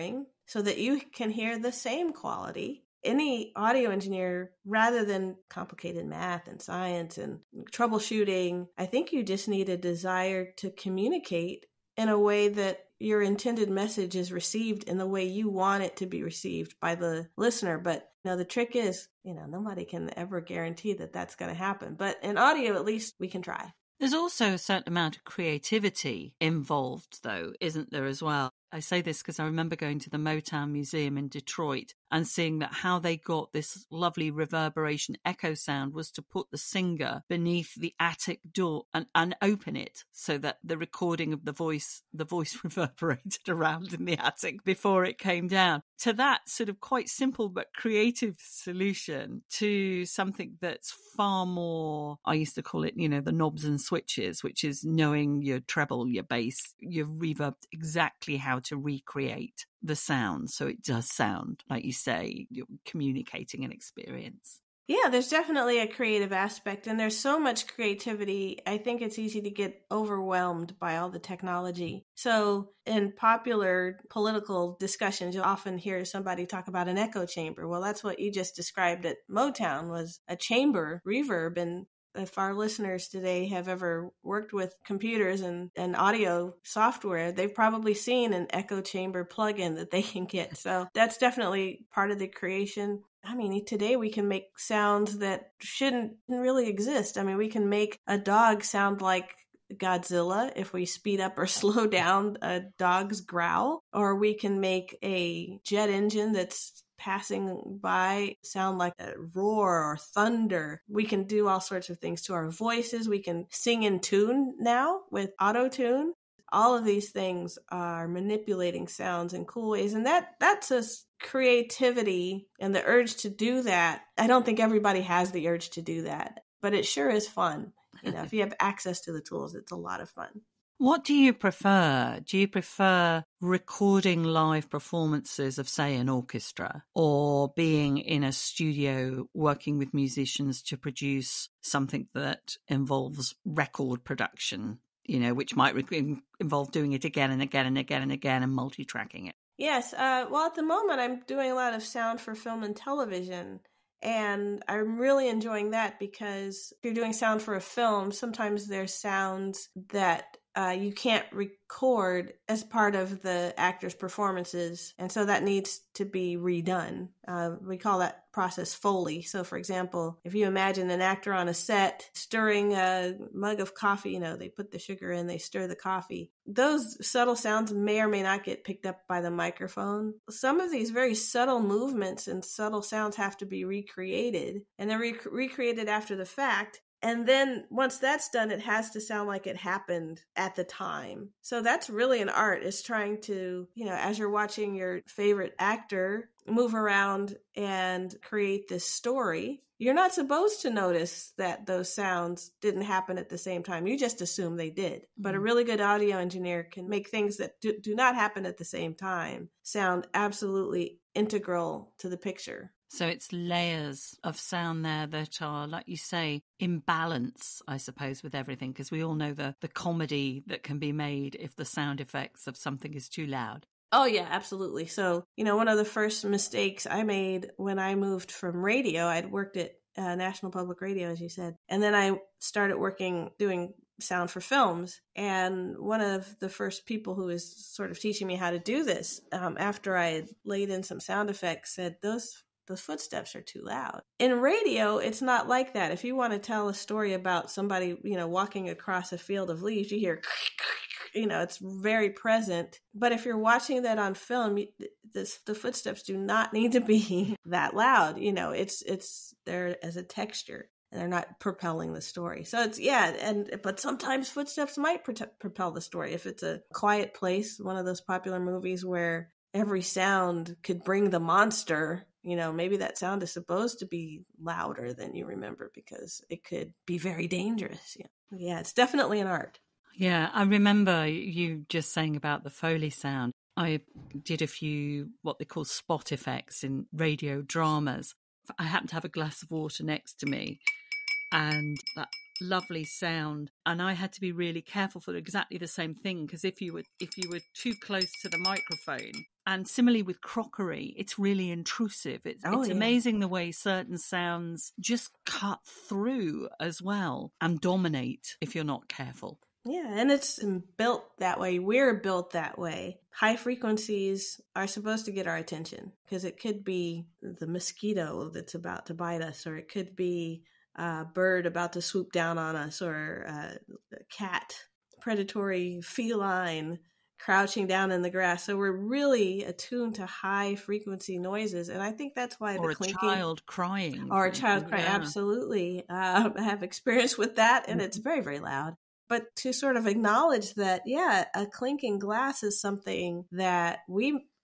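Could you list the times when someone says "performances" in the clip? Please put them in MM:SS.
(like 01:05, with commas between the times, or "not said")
02:14, 02:43.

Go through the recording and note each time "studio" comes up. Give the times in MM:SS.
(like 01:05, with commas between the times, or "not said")
02:18.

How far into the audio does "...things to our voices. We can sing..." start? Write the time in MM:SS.
01:51.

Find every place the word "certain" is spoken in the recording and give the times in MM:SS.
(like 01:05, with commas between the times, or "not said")
00:24, 05:03.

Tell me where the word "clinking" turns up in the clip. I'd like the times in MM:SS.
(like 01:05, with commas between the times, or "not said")
05:32, 05:41.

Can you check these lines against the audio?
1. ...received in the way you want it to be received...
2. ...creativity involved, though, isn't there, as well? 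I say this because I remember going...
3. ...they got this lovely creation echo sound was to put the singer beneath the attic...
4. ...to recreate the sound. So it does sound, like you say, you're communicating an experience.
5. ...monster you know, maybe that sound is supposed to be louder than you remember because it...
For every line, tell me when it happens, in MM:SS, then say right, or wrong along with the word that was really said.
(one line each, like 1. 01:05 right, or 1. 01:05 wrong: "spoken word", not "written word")
1. 00:14 right
2. 00:25 right
3. 00:32 wrong: "reverberation", not "creation"
4. 00:58 right
5. 04:31 right.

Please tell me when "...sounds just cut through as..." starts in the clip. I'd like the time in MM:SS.
05:03.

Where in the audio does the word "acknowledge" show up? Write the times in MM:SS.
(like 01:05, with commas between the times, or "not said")
05:39.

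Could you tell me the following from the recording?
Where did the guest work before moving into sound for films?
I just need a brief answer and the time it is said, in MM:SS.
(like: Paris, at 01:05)
National Public Radio, at 03:50.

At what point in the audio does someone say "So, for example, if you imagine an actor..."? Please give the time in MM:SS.
02:49.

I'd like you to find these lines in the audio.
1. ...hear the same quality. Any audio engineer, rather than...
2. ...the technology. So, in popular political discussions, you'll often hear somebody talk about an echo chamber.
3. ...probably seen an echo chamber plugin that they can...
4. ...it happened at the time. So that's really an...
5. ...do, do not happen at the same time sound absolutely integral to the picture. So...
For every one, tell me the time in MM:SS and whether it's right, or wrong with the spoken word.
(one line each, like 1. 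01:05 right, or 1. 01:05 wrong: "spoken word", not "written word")
1. 00:01 right
2. 01:11 right
3. 01:27 right
4. 03:09 right
5. 03:27 right.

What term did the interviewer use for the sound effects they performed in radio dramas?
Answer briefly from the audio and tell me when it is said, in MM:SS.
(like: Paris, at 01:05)
Spot effects, at 04:45.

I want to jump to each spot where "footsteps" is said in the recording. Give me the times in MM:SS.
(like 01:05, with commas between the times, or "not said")
04:02, 04:15, 04:24.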